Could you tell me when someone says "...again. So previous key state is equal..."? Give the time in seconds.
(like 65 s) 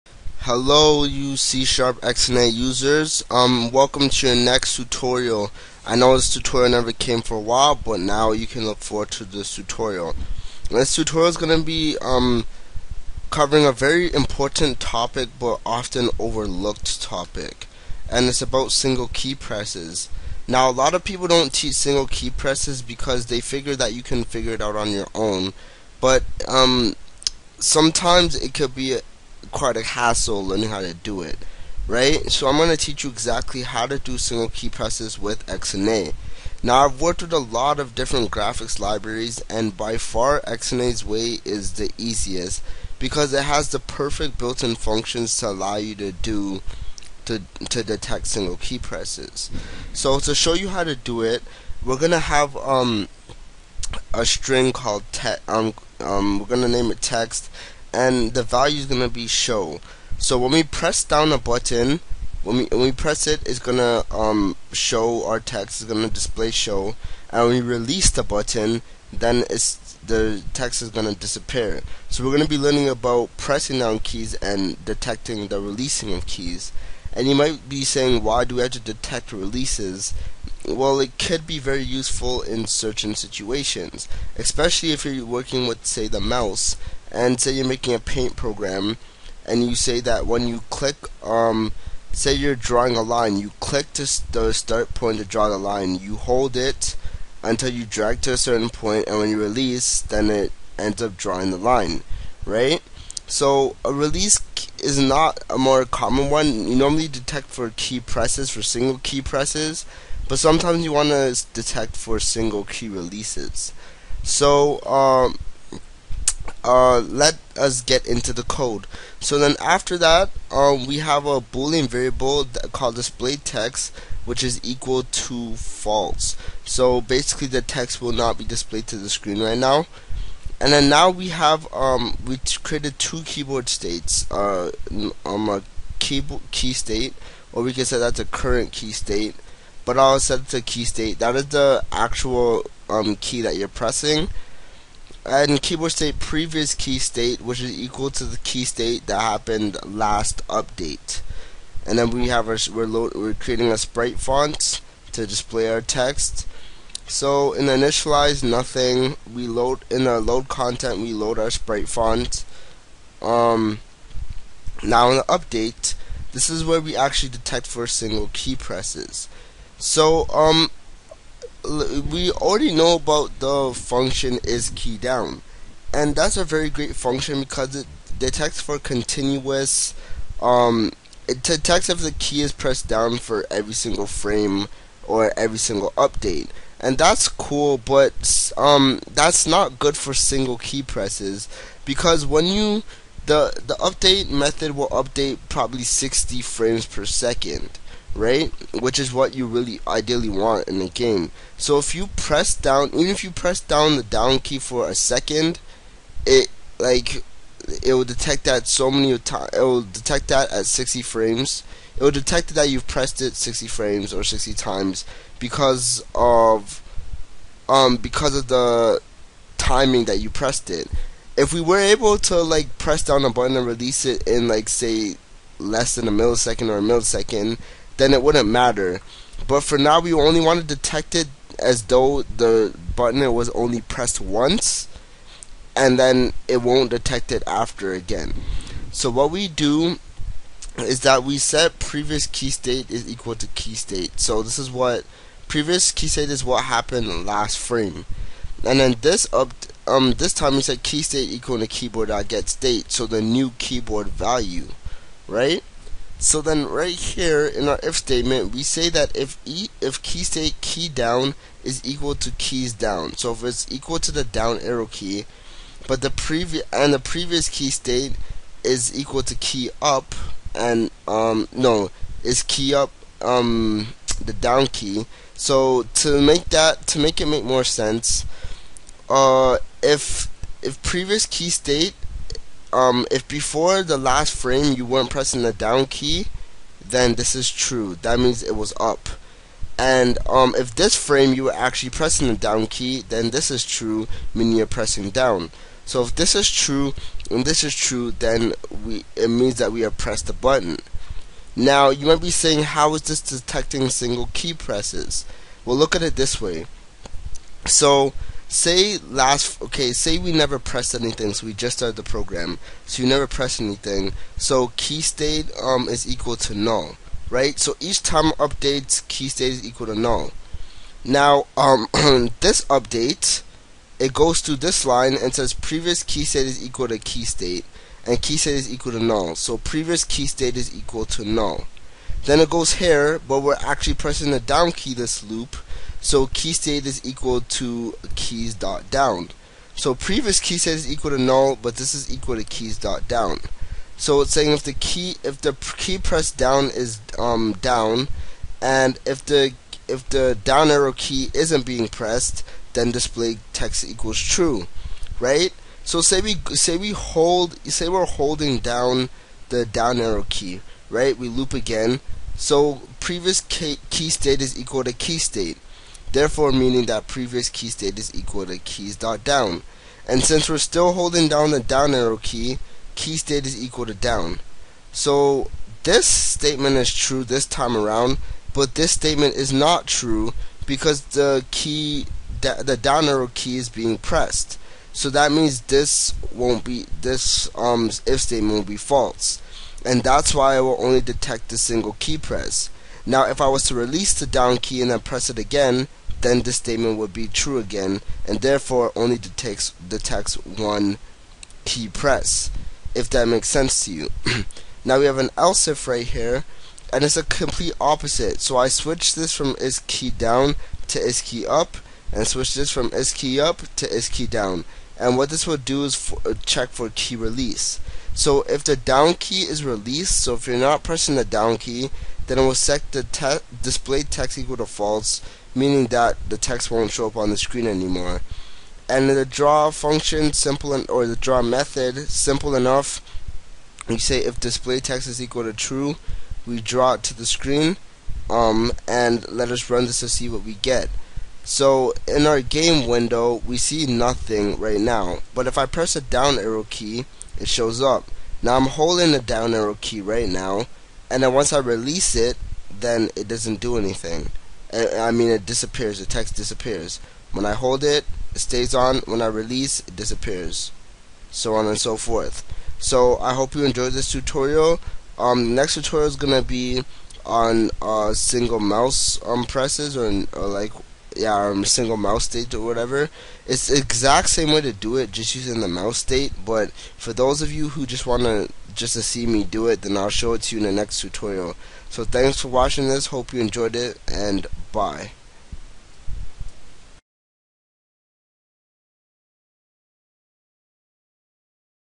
361 s.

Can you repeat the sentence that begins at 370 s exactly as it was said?
And since we're still holding down the down arrow key, key state is equal to down.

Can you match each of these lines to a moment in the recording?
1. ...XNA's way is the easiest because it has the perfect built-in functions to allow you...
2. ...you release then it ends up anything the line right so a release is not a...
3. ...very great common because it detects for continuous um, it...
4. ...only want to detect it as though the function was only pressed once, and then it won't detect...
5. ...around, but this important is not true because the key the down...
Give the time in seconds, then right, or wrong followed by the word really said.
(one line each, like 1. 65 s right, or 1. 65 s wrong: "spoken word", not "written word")
1. 40 s right
2. 99 s wrong: "drawing", not "anything"
3. 176 s wrong: "function", not "common"
4. 230 s wrong: "button", not "function"
5. 377 s wrong: "statement", not "important".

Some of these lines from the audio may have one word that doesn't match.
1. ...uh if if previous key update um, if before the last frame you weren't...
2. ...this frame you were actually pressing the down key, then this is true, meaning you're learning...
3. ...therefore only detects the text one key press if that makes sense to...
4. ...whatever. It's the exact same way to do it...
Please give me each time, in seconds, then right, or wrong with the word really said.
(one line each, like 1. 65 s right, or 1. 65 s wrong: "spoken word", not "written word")
1. 279 s wrong: "state", not "update"
2. 290 s wrong: "pressing", not "learning"
3. 398 s right
4. 472 s right.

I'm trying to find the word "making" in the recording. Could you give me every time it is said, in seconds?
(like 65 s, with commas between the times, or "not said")
87 s.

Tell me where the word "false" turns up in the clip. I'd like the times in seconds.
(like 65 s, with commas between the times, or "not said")
125 s, 388 s, 424 s.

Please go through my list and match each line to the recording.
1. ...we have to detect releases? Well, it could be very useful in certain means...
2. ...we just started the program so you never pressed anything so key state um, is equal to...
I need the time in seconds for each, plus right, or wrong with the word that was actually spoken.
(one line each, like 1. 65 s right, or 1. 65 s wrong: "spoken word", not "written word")
1. 78 s wrong: "situations", not "means"
2. 311 s right.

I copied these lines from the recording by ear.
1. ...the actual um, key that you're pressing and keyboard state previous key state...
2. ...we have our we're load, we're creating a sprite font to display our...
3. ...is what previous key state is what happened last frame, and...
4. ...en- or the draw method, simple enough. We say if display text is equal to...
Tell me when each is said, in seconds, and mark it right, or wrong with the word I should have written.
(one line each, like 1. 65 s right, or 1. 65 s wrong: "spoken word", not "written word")
1. 141 s right
2. 152 s right
3. 244 s right
4. 430 s right.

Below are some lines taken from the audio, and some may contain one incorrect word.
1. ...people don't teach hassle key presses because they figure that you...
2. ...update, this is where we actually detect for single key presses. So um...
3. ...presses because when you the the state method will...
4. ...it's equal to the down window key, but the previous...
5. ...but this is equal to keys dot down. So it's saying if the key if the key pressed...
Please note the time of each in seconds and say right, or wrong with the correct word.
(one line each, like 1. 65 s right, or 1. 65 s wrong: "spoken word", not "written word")
1. 21 s wrong: "single", not "hassle"
2. 165 s right
3. 190 s wrong: "update", not "state"
4. 263 s wrong: "arrow", not "window"
5. 341 s right.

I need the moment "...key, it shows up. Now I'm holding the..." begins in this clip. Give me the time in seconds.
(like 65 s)
446 s.